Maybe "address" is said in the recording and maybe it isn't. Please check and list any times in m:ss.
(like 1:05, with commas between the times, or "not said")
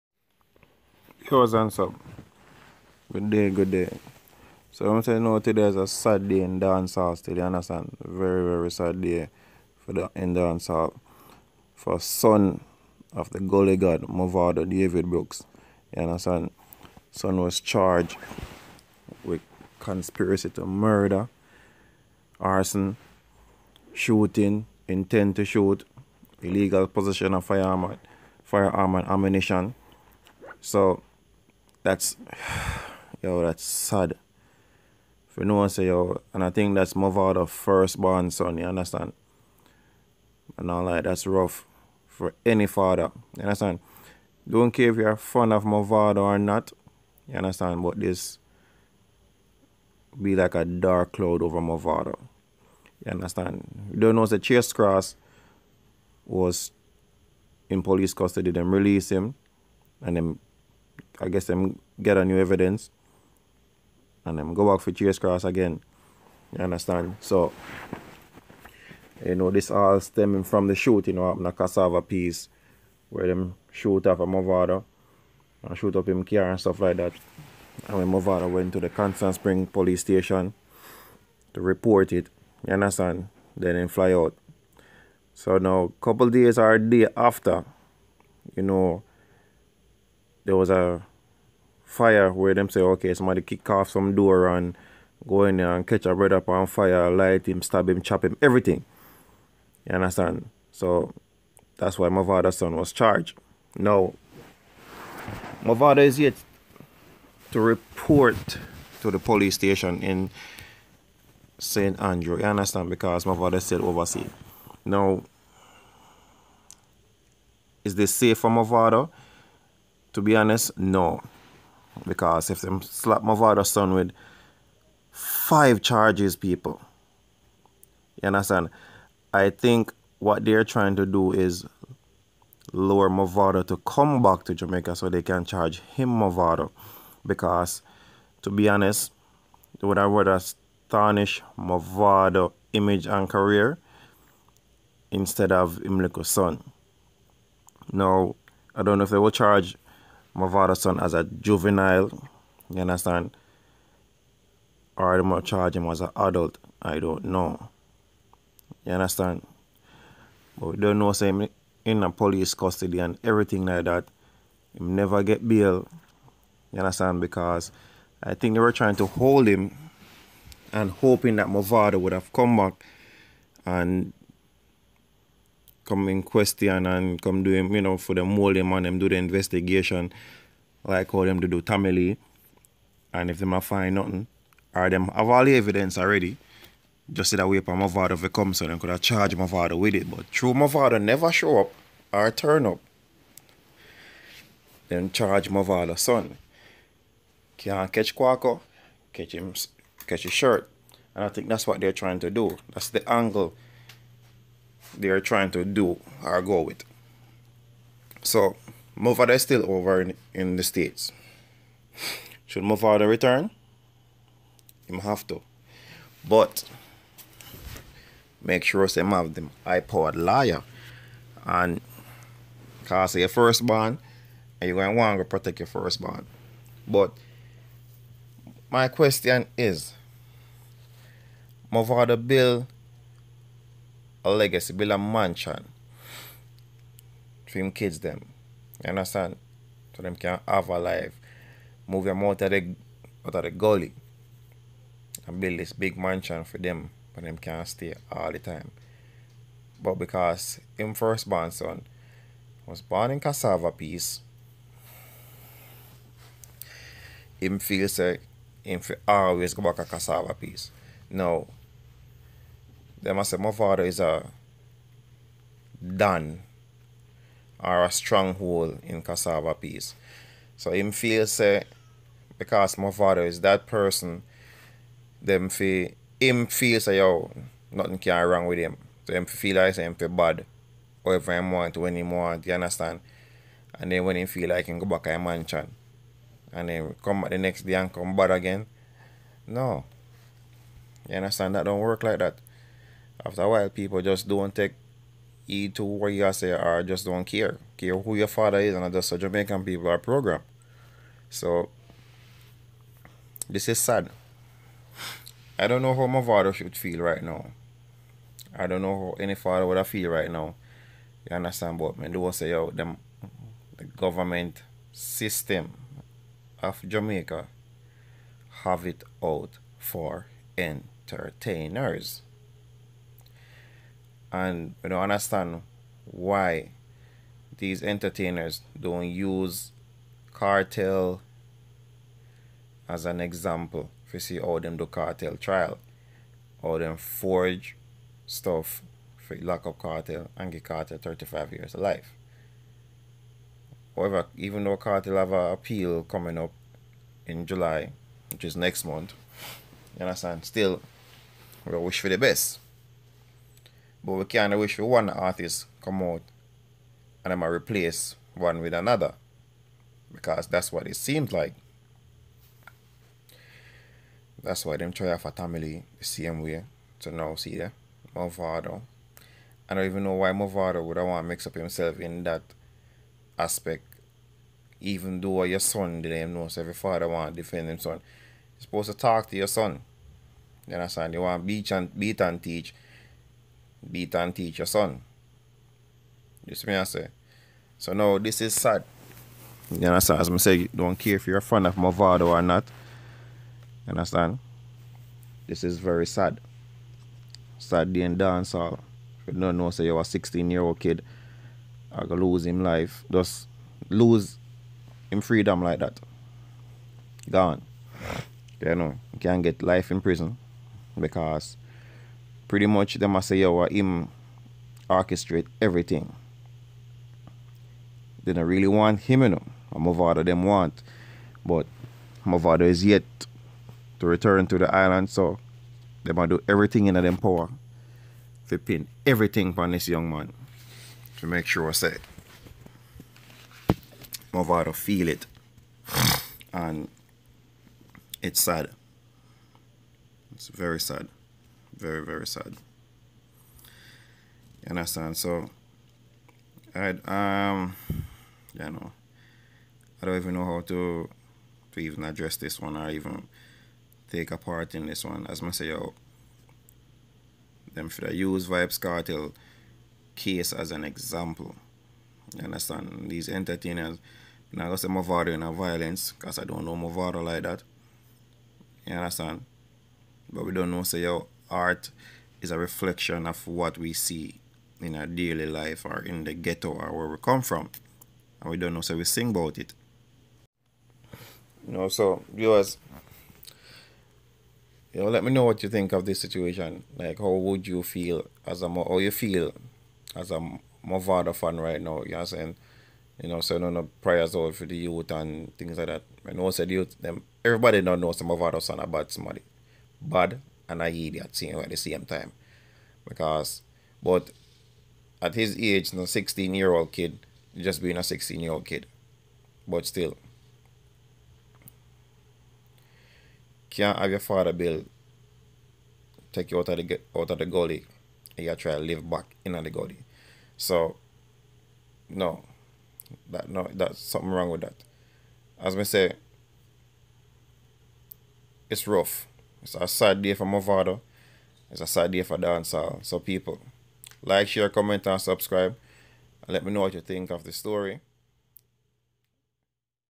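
7:32.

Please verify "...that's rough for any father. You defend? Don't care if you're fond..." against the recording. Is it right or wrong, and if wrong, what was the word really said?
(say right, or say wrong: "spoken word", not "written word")
wrong: "understand", not "defend".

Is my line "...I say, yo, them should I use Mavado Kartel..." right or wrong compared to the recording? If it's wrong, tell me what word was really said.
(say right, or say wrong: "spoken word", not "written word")
wrong: "Vybz", not "Mavado".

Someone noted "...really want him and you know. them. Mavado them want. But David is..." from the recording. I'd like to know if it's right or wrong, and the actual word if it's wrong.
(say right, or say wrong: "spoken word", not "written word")
wrong: "Mavado", not "David".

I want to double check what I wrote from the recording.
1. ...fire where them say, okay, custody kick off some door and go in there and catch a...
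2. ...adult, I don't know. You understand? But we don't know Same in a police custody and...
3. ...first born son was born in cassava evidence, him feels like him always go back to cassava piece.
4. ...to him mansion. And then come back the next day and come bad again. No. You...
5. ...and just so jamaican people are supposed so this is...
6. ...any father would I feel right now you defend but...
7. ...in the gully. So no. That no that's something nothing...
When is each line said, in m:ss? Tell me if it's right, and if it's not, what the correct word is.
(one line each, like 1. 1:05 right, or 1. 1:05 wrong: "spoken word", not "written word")
1. 1:31 wrong: "somebody", not "custody"
2. 2:36 right
3. 4:10 wrong: "piece", not "evidence"
4. 4:45 right
5. 4:58 wrong: "programmed", not "supposed"
6. 5:09 wrong: "understand", not "defend"
7. 8:39 wrong: "wrong", not "nothing".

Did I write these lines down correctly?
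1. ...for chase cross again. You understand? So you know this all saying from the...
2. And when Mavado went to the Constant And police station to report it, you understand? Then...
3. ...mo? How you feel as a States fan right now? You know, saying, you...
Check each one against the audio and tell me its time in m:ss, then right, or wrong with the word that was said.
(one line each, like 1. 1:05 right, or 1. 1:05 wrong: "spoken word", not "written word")
1. 1:04 wrong: "stemming", not "saying"
2. 1:17 wrong: "Spring", not "And"
3. 8:08 wrong: "Mavado", not "States".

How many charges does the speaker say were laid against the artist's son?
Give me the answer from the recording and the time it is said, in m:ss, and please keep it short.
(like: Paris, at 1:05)
5, at 2:05.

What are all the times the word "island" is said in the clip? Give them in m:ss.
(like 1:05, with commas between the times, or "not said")
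7:04.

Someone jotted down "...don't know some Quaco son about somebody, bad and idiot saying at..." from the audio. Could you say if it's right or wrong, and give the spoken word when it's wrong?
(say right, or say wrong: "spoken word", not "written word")
wrong: "Mavado", not "Quaco".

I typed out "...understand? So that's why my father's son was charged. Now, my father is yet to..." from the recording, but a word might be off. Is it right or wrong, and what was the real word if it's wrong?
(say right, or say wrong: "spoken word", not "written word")
right.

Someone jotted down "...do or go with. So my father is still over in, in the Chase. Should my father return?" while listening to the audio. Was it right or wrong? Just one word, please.
wrong.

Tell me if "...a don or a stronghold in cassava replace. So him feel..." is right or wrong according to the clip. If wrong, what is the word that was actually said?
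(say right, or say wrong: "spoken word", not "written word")
wrong: "piece", not "replace".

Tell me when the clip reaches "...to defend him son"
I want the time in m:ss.
6:17.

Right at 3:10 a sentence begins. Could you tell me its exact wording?
But true my father never show up or turn up.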